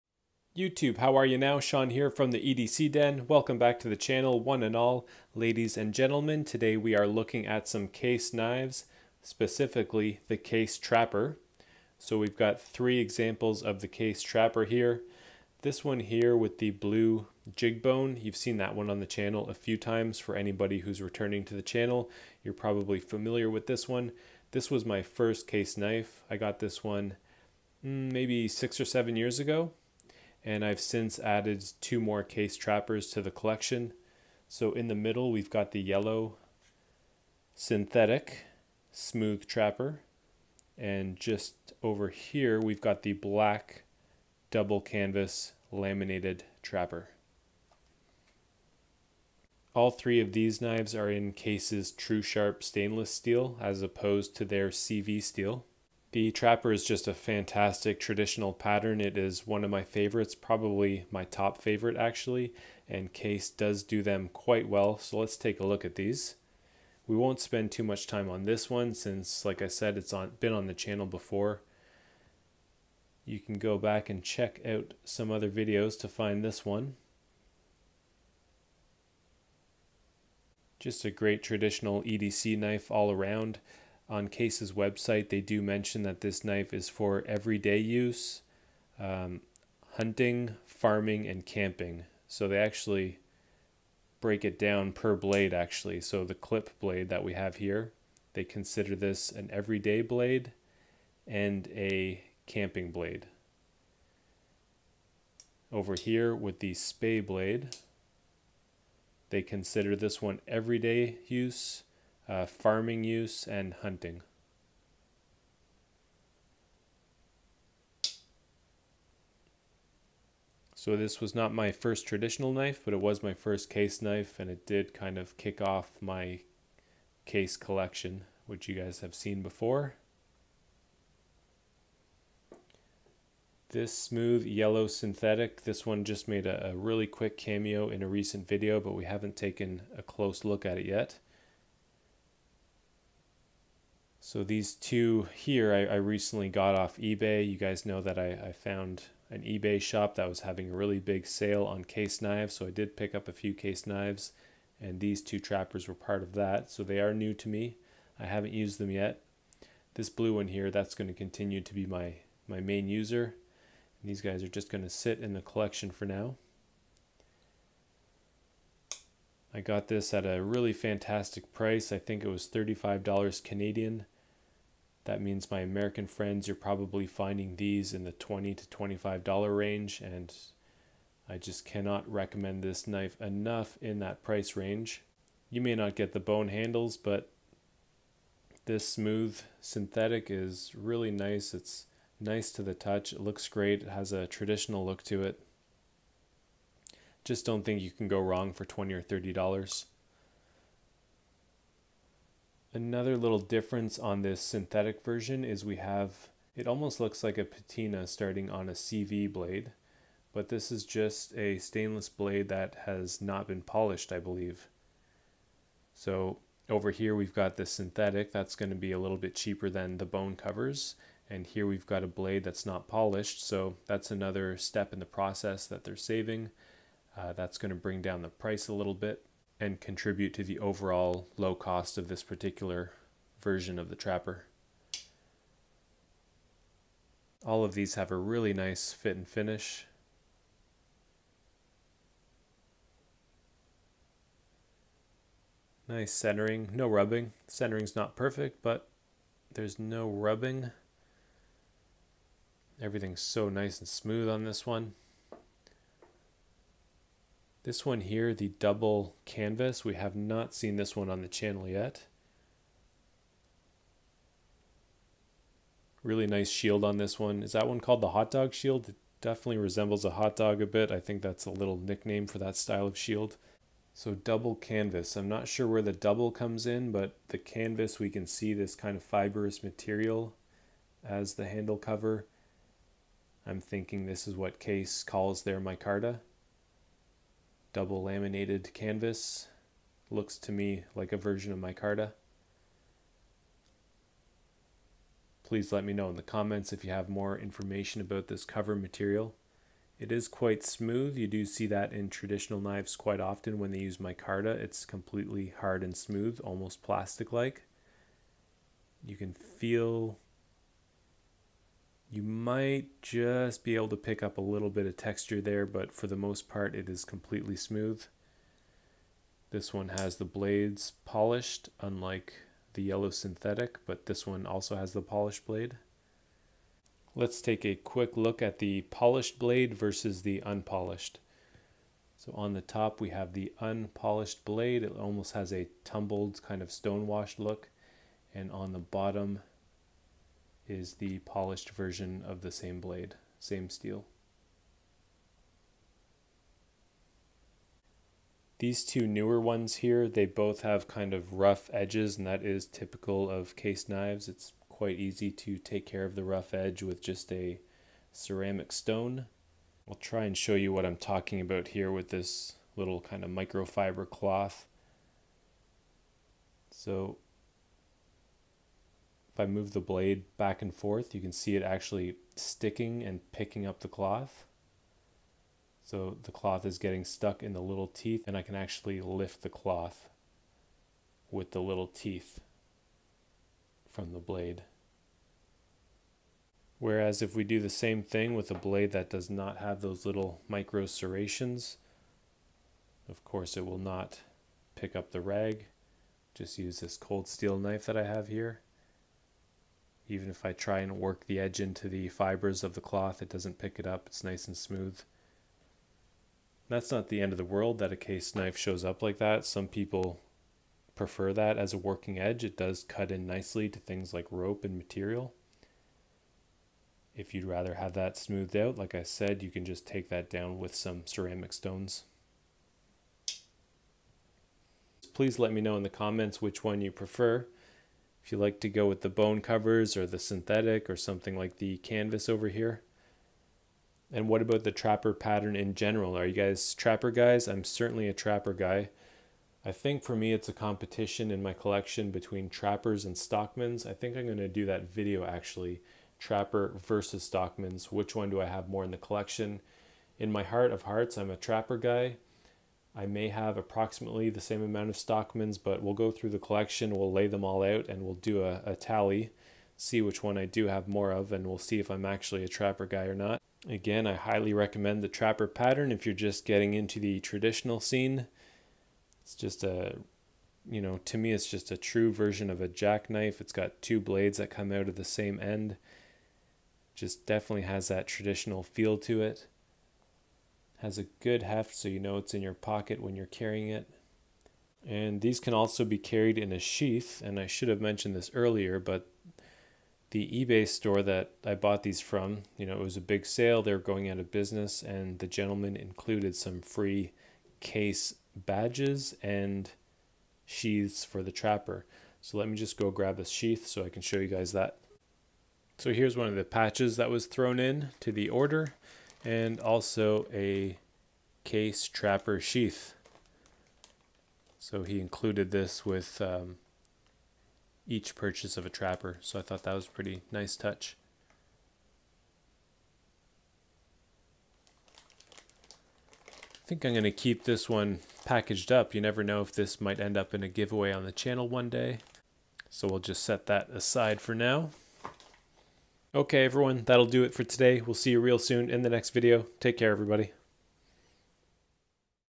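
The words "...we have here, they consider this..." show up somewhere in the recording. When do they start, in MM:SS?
01:37.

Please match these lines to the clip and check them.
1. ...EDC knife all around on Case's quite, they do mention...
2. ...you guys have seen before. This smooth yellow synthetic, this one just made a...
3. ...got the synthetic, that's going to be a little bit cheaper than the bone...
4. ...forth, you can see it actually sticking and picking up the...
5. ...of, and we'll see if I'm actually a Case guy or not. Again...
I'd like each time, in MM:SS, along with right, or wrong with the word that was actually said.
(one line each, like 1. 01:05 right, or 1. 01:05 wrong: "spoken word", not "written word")
1. 01:22 wrong: "website", not "quite"
2. 02:08 right
3. 03:37 right
4. 06:10 right
5. 07:41 wrong: "Trapper", not "Case".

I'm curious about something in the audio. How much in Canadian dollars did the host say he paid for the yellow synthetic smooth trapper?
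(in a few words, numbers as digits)
$35.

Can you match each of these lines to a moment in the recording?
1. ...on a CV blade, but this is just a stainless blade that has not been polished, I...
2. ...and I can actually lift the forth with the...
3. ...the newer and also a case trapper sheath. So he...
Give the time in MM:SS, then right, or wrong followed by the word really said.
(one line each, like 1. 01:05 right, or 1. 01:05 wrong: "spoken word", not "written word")
1. 03:28 right
2. 06:18 wrong: "cloth", not "forth"
3. 08:28 wrong: "order", not "newer".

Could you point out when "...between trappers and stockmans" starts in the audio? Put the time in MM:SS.
07:22.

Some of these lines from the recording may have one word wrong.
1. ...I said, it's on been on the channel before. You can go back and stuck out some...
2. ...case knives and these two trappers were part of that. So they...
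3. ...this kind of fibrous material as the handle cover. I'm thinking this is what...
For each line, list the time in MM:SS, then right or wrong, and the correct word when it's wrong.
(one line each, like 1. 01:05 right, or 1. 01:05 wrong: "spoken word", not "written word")
1. 01:09 wrong: "check", not "stuck"
2. 02:33 right
3. 04:38 right.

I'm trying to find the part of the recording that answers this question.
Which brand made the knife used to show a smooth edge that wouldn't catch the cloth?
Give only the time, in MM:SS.
06:36.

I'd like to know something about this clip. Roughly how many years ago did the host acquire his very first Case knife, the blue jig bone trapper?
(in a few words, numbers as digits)
6 or 7 years.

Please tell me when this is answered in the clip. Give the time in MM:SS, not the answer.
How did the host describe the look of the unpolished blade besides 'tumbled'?
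05:36.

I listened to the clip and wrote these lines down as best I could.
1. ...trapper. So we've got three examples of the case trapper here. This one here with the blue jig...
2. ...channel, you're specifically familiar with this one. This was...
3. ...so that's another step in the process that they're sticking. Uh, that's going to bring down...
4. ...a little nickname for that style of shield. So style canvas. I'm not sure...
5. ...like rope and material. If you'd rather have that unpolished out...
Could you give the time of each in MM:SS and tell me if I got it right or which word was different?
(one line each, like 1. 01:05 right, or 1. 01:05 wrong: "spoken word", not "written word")
1. 00:10 right
2. 00:21 wrong: "probably", not "specifically"
3. 03:43 wrong: "saving", not "sticking"
4. 04:31 wrong: "double", not "style"
5. 06:54 wrong: "smoothed", not "unpolished".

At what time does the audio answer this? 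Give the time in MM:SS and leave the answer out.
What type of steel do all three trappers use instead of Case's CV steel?
00:51.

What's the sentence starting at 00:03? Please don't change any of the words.
Welcome back to the channel, one and all, ladies and gentlemen.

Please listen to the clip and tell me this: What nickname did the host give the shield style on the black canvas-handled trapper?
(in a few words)
Hot dog shield.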